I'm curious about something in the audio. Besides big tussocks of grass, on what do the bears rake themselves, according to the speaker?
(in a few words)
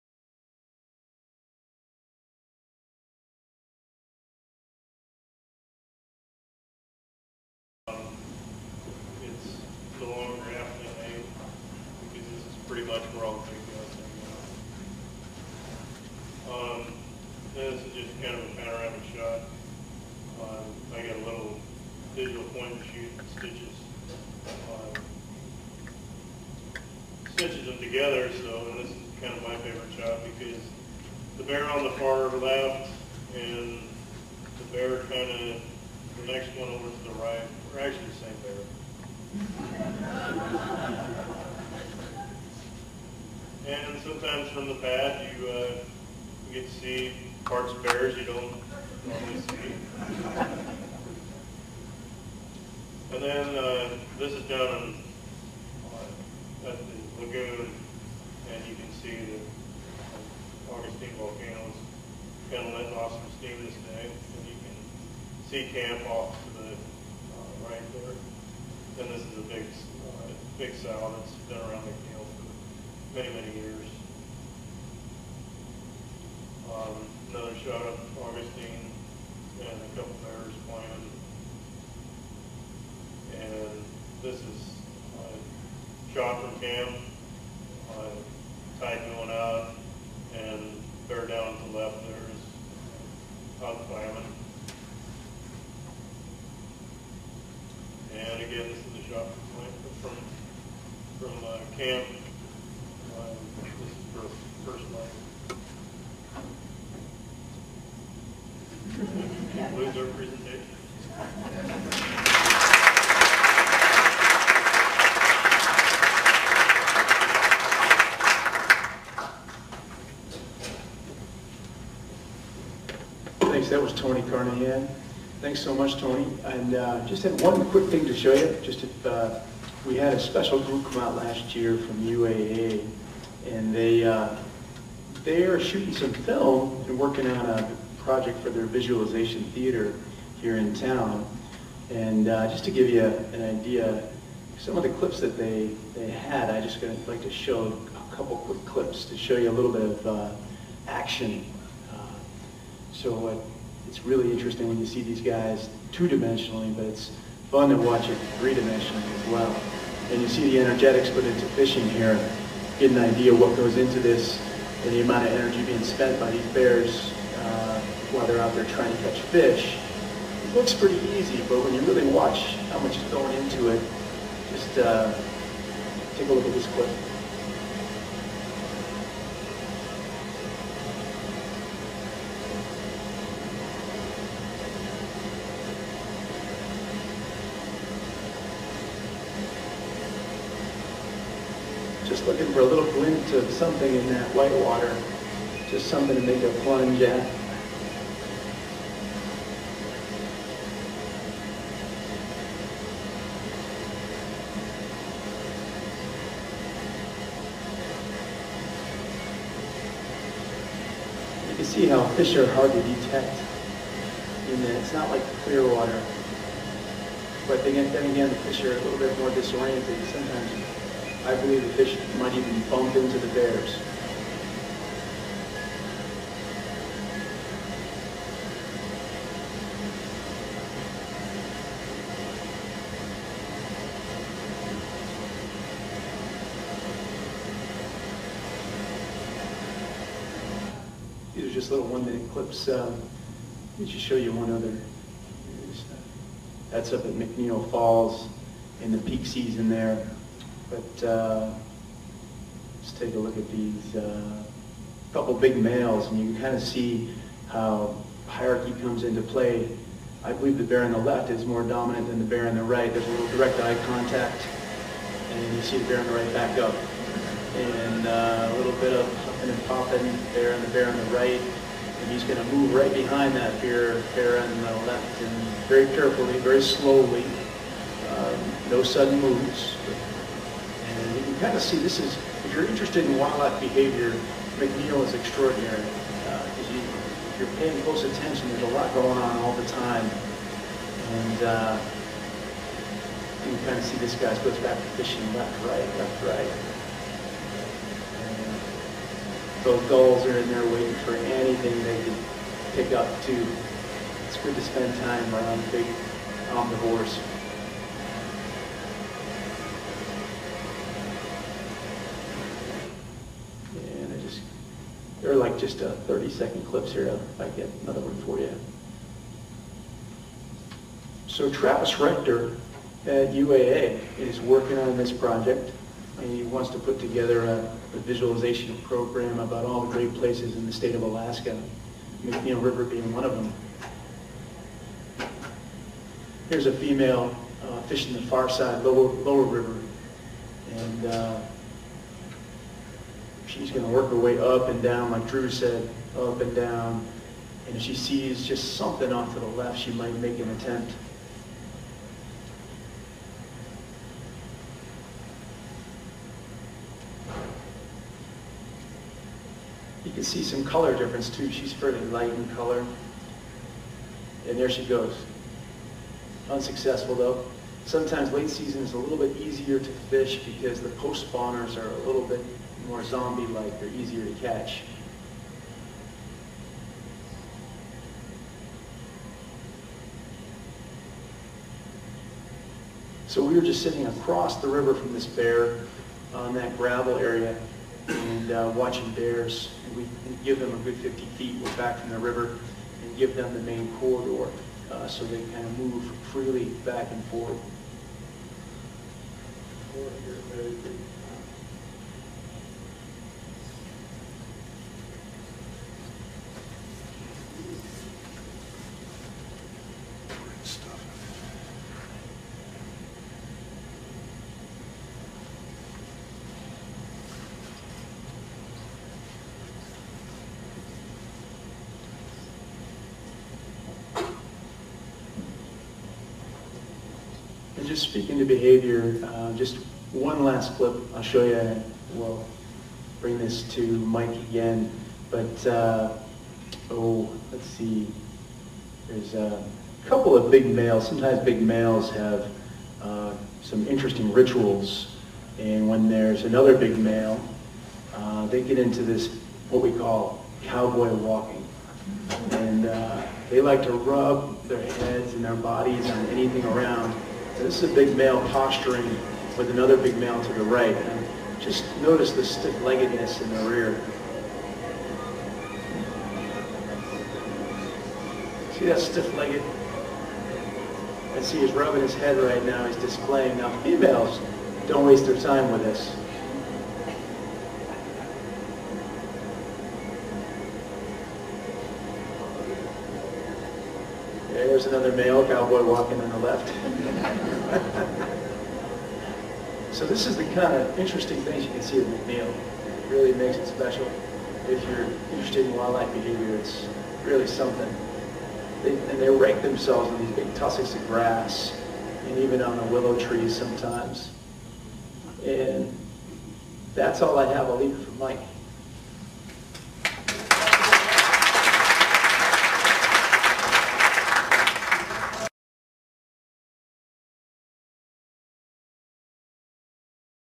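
willow trees.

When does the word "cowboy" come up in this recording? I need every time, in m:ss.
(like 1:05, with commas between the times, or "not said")
7:30, 8:05.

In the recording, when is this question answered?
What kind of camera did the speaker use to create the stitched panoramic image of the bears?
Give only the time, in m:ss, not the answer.
0:22.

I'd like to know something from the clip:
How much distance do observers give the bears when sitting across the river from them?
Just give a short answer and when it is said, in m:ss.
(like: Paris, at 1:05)
50 feet, at 6:30.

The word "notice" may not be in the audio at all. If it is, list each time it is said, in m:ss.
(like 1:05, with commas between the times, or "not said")
7:42.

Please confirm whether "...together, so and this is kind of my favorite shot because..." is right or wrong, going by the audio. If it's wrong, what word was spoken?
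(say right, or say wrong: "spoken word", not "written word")
right.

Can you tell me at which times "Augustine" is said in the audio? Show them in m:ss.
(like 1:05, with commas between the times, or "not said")
1:00, 1:18.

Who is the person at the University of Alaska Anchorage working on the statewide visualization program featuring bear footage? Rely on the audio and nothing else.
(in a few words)
Travis Rector.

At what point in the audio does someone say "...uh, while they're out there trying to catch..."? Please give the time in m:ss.
2:47.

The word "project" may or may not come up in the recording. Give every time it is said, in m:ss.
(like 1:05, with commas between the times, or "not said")
2:18, 5:25.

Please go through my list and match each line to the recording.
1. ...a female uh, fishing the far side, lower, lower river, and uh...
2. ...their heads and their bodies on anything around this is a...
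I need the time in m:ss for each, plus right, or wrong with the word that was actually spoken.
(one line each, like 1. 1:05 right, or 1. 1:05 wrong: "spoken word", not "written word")
1. 5:36 right
2. 7:34 right.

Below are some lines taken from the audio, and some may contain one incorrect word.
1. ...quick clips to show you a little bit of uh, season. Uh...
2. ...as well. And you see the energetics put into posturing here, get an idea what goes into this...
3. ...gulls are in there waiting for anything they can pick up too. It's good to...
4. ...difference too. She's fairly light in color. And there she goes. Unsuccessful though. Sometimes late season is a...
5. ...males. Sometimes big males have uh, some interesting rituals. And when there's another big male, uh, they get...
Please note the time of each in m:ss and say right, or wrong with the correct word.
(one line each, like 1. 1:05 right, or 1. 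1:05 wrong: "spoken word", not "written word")
1. 2:28 wrong: "action", not "season"
2. 2:39 wrong: "fishing", not "posturing"
3. 4:59 right
4. 6:00 right
5. 7:20 right.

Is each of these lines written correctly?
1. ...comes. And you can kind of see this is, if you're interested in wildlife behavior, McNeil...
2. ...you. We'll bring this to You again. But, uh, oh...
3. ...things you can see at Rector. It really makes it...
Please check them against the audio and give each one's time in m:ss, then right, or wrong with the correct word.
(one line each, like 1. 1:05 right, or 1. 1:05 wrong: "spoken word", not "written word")
1. 4:39 wrong: "moves", not "comes"
2. 7:11 wrong: "Mike", not "You"
3. 8:11 wrong: "McNeil", not "Rector".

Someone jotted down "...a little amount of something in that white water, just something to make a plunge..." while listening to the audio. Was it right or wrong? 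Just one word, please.
wrong.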